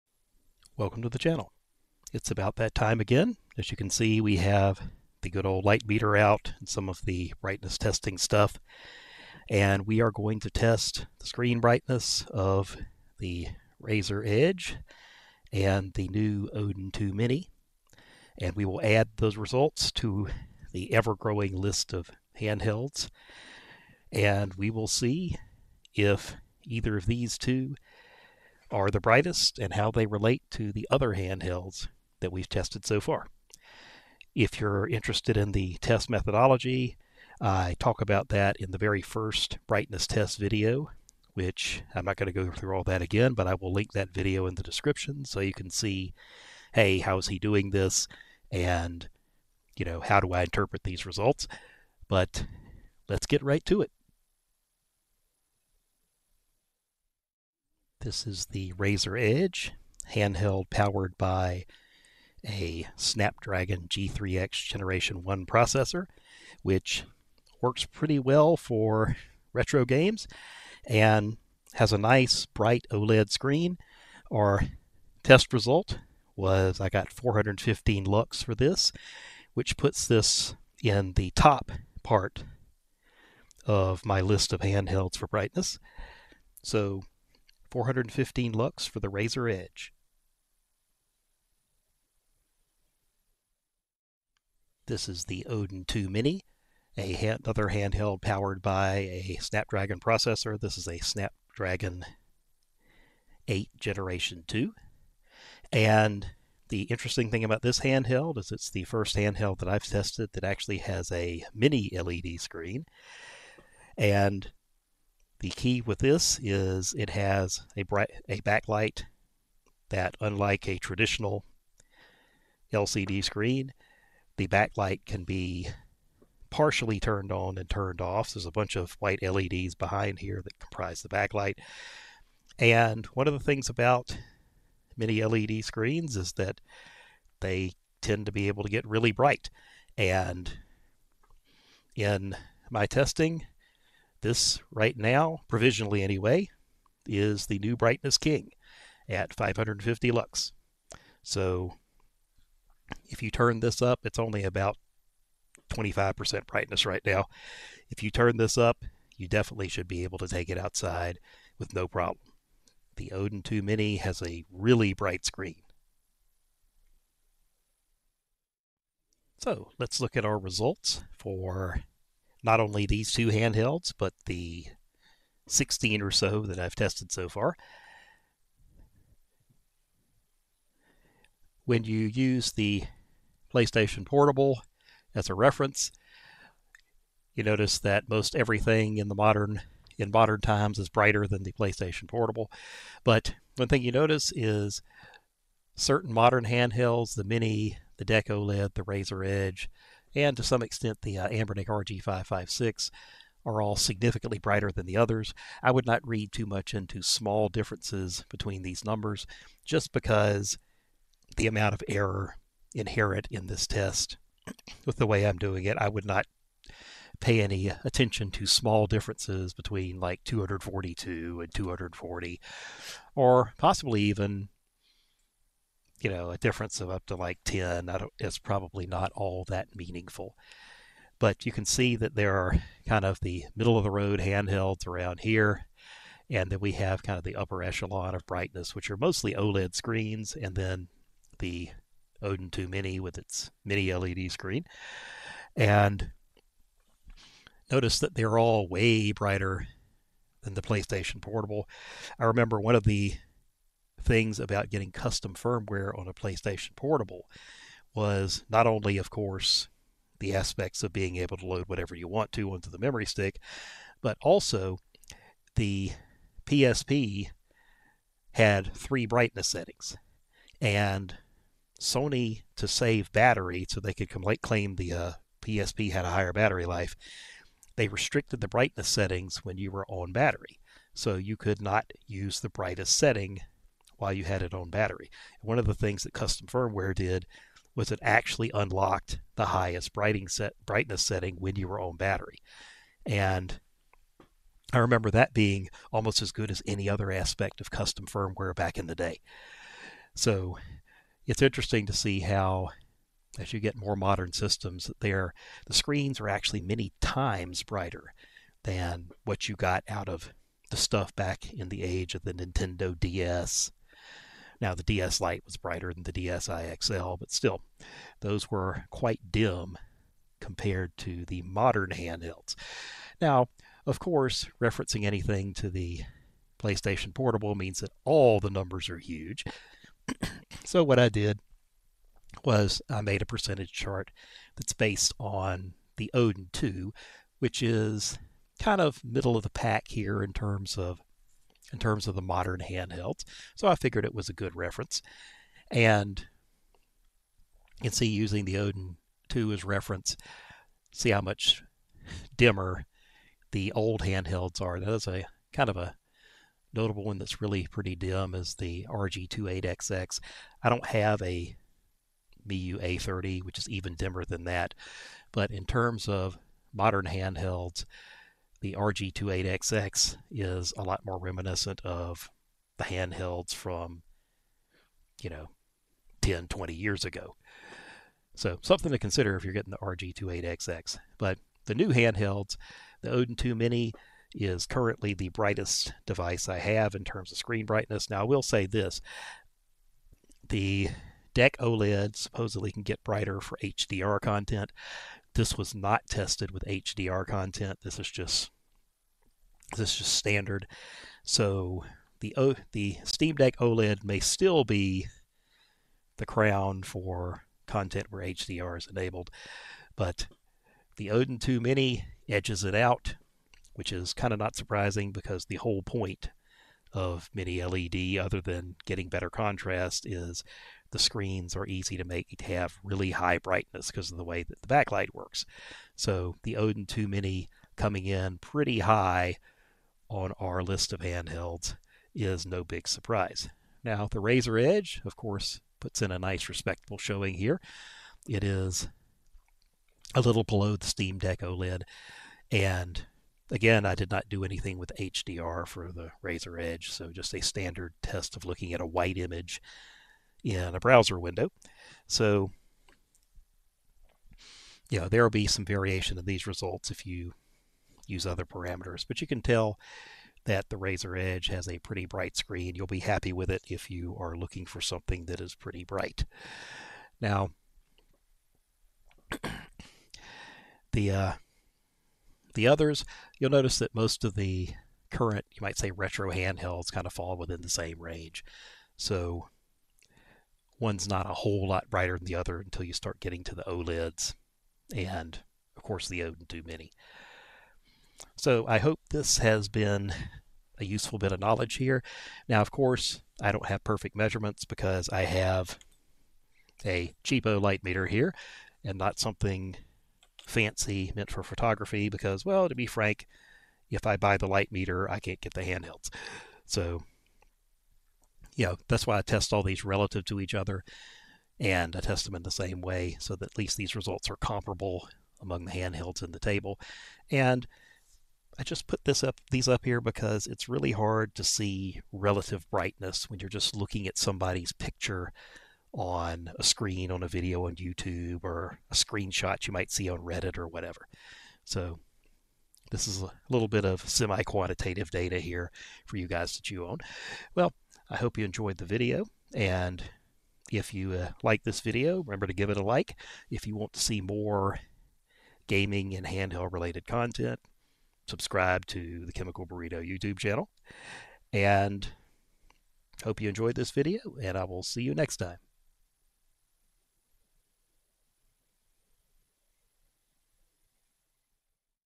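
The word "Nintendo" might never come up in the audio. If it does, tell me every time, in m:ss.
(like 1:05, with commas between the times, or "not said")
5:12.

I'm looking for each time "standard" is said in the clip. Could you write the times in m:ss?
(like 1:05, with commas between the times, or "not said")
6:40, 7:27.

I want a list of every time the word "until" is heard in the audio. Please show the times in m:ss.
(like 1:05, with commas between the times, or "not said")
8:02.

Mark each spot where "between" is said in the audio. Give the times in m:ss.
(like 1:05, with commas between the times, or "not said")
3:28, 3:39.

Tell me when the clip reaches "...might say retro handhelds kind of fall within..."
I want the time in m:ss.
7:55.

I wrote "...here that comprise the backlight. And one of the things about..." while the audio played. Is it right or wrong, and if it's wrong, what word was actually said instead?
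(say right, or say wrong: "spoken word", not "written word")
right.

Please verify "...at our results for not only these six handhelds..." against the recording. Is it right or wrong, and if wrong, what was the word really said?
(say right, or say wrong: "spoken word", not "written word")
wrong: "two", not "six".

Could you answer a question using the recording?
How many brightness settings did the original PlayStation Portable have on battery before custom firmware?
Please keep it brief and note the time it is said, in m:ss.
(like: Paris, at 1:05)
3, at 4:28.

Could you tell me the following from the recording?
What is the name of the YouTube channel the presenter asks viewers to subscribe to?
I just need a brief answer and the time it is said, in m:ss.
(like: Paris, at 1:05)
Chemical Burrito, at 9:09.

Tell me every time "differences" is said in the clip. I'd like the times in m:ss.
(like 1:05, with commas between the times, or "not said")
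3:27, 3:38, 3:46.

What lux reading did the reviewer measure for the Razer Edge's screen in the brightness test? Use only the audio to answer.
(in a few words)
415 lux.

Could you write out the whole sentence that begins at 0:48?
And, you know, how do I interpret these results?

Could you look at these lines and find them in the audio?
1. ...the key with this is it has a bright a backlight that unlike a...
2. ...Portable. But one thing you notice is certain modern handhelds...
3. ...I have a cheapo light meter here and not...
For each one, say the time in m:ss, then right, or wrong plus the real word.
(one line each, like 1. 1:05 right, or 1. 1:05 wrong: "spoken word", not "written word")
1. 1:55 right
2. 3:12 right
3. 8:15 right.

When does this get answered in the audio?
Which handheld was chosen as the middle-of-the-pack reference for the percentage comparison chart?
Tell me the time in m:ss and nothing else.
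5:34.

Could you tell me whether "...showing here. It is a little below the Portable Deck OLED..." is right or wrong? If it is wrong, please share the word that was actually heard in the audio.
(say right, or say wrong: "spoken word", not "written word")
wrong: "Steam", not "Portable".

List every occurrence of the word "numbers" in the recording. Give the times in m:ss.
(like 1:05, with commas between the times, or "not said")
3:28, 5:28.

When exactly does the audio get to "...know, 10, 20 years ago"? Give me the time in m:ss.
6:15.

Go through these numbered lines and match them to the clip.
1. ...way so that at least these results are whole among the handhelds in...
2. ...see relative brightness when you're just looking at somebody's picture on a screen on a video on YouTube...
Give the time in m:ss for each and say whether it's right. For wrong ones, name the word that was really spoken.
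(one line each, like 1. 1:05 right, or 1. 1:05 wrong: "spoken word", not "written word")
1. 8:32 wrong: "comparable", not "whole"
2. 8:41 right.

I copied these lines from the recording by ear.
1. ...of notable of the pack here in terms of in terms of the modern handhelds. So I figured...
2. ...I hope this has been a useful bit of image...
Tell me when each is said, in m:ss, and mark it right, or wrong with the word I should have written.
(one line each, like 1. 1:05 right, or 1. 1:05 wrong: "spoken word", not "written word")
1. 5:38 wrong: "middle", not "notable"
2. 8:08 wrong: "knowledge", not "image".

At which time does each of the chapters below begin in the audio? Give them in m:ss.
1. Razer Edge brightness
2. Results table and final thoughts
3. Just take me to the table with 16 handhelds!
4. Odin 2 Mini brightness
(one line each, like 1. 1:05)
1. 0:57
2. 2:48
3. 5:30
4. 1:34.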